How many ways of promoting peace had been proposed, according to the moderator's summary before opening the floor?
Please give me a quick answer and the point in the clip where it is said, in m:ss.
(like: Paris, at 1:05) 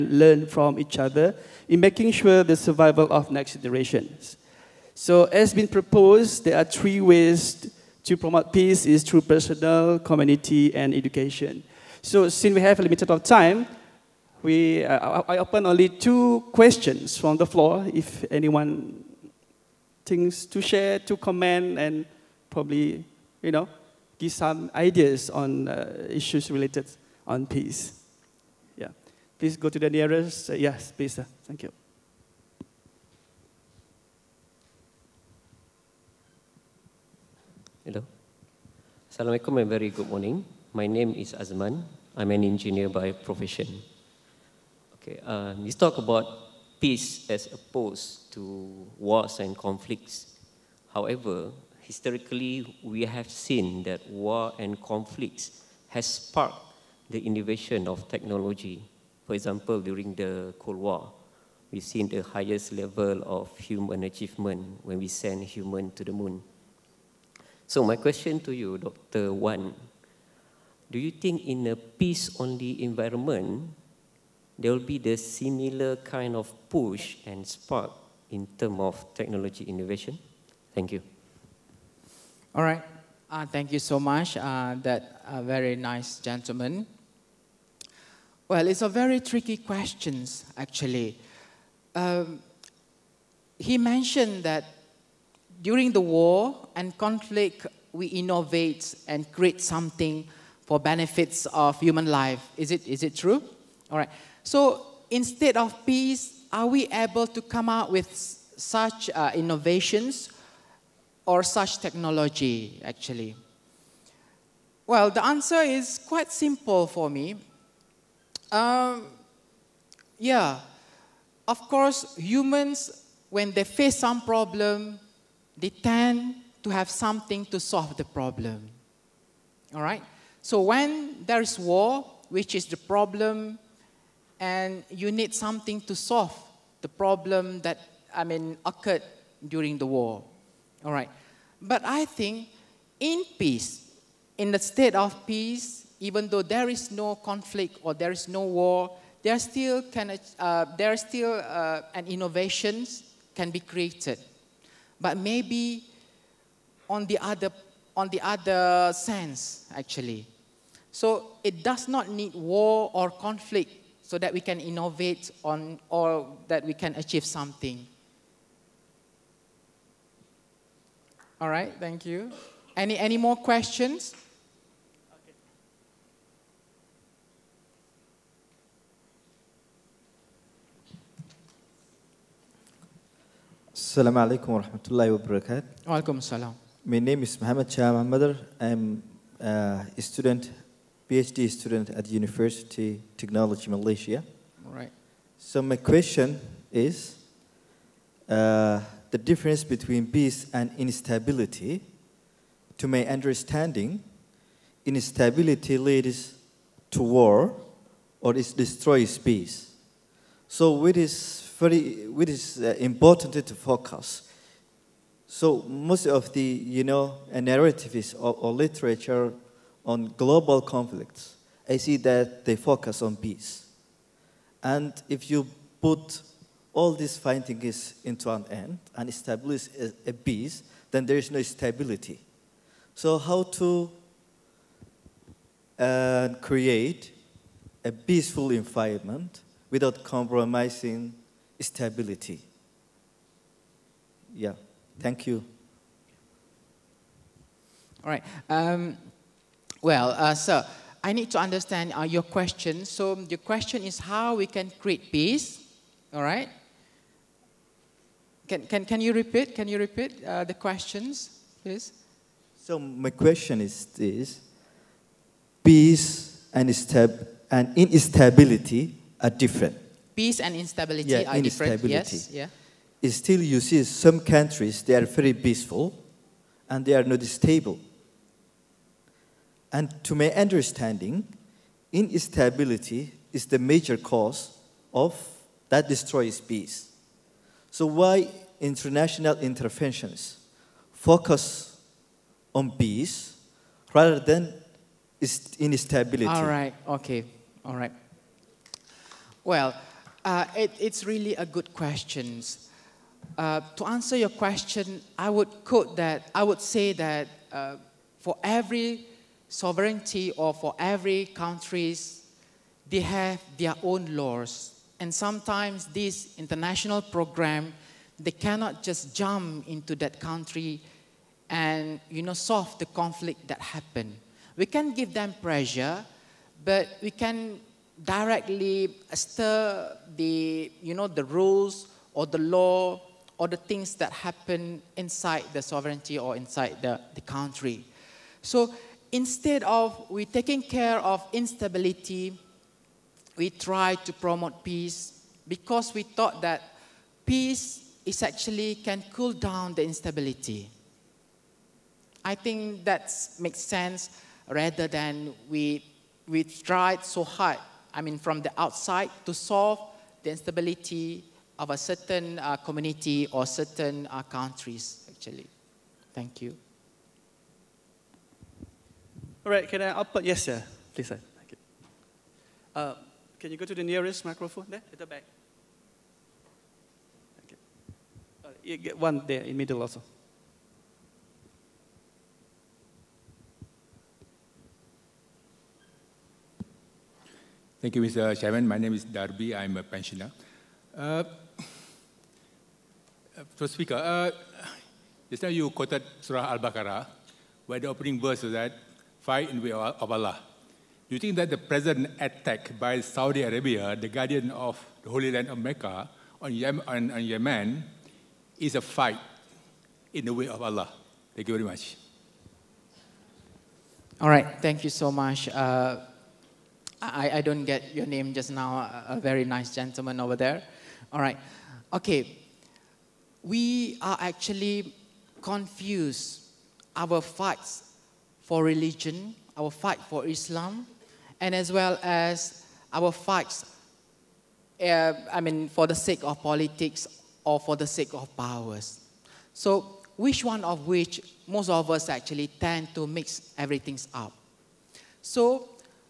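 3, at 0:06.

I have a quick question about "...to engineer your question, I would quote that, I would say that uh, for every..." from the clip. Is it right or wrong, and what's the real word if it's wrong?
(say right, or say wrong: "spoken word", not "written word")
wrong: "answer", not "engineer".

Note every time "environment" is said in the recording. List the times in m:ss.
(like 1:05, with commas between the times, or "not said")
1:12, 3:58.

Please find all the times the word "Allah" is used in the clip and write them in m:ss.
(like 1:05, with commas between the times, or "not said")
6:40, 6:50.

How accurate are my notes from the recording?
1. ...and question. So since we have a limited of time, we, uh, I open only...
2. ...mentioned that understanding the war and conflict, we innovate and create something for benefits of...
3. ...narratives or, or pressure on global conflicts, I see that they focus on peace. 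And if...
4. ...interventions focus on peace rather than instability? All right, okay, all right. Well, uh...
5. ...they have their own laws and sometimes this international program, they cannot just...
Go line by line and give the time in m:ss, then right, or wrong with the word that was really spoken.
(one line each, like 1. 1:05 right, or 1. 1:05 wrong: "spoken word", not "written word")
1. 0:10 wrong: "education", not "question"
2. 1:33 wrong: "during", not "understanding"
3. 3:37 wrong: "literature", not "pressure"
4. 4:49 right
5. 5:12 right.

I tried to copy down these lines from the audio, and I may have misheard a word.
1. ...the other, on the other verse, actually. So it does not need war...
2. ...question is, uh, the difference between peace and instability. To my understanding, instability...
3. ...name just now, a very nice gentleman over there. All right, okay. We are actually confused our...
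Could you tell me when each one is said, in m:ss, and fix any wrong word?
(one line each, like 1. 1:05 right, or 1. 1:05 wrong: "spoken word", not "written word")
1. 2:37 wrong: "sense", not "verse"
2. 3:15 right
3. 6:58 right.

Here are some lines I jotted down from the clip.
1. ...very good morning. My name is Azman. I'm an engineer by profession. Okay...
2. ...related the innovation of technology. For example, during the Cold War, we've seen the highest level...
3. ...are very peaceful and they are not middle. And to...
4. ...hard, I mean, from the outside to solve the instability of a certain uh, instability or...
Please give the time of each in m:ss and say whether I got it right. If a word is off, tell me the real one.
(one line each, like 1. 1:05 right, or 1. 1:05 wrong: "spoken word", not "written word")
1. 0:39 right
2. 0:56 wrong: "sparked", not "related"
3. 4:34 wrong: "stable", not "middle"
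4. 5:57 wrong: "community", not "instability".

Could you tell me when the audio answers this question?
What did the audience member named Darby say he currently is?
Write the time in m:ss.
6:29.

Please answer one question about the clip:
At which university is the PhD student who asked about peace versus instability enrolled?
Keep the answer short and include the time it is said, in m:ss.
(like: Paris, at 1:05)
University Technology Malaysia, at 3:12.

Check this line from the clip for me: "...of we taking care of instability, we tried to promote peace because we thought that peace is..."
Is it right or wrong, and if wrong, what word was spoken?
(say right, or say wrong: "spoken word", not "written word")
right.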